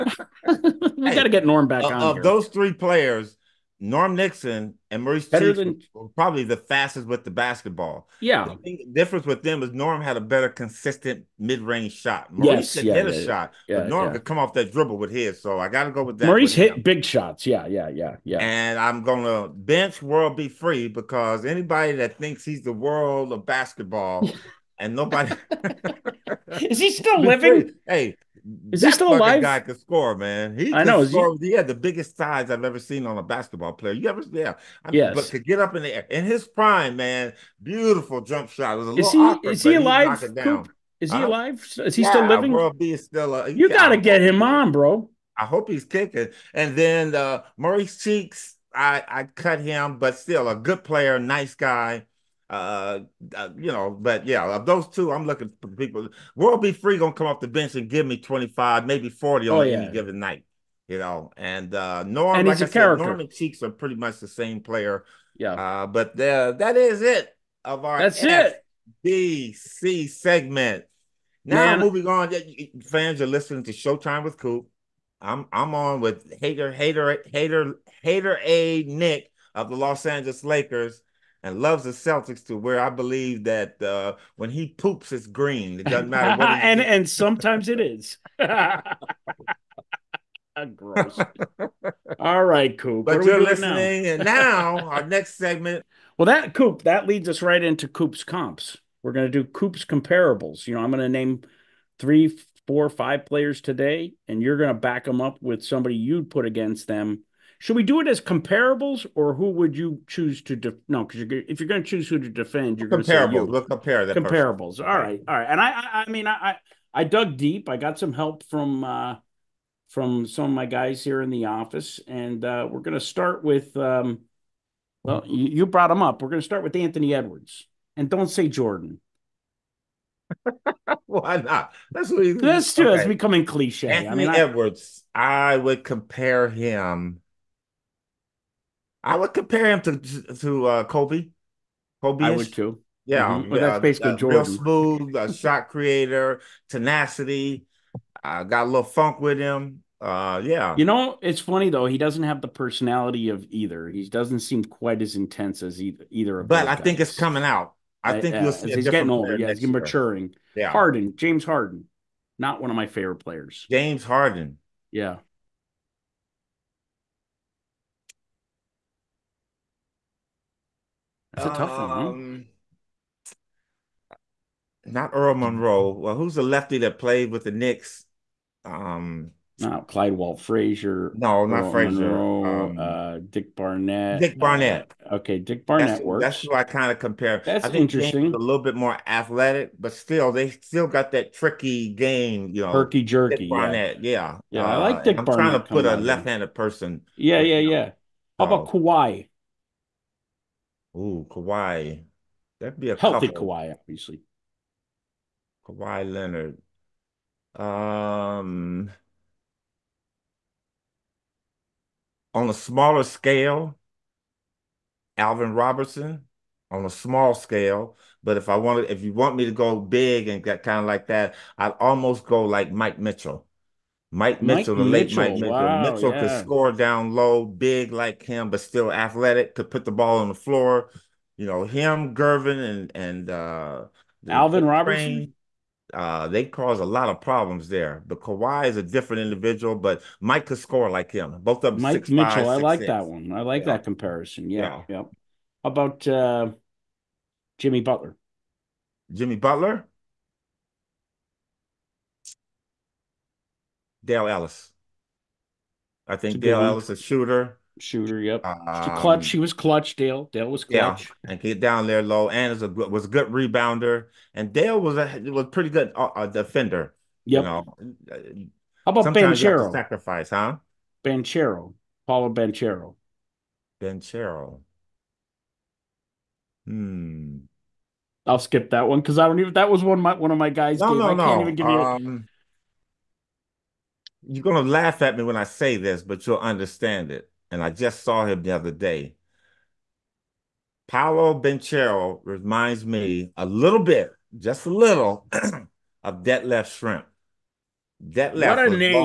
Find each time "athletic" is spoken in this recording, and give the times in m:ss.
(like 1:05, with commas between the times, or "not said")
3:09, 3:48.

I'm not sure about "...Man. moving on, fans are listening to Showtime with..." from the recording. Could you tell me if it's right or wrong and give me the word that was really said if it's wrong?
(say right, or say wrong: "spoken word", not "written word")
right.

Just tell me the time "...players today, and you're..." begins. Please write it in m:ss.
1:43.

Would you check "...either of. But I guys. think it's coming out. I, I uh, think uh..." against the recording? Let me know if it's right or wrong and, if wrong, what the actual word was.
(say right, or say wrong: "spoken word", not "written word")
right.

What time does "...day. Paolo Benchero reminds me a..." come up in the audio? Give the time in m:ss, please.
4:48.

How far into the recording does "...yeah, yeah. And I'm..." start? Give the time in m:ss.
0:17.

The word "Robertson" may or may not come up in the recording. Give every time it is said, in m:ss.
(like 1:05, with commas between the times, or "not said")
3:35, 3:54.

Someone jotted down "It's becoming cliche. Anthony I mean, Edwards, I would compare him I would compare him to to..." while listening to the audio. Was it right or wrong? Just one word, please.
right.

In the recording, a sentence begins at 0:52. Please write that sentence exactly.
Uh, uh, you know, but yeah, of those two, I'm looking for people.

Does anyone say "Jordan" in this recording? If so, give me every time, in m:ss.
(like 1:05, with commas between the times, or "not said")
2:08, 2:24.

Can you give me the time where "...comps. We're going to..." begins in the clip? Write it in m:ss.
1:38.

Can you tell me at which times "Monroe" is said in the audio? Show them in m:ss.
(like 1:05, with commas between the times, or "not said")
2:55, 3:02.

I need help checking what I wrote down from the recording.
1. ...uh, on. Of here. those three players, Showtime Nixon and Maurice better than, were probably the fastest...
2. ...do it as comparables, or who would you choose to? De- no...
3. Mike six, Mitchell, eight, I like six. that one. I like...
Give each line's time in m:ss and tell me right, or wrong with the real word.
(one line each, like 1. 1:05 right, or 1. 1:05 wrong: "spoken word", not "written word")
1. 0:01 wrong: "Norm", not "Showtime"
2. 1:47 right
3. 4:01 wrong: "five", not "eight".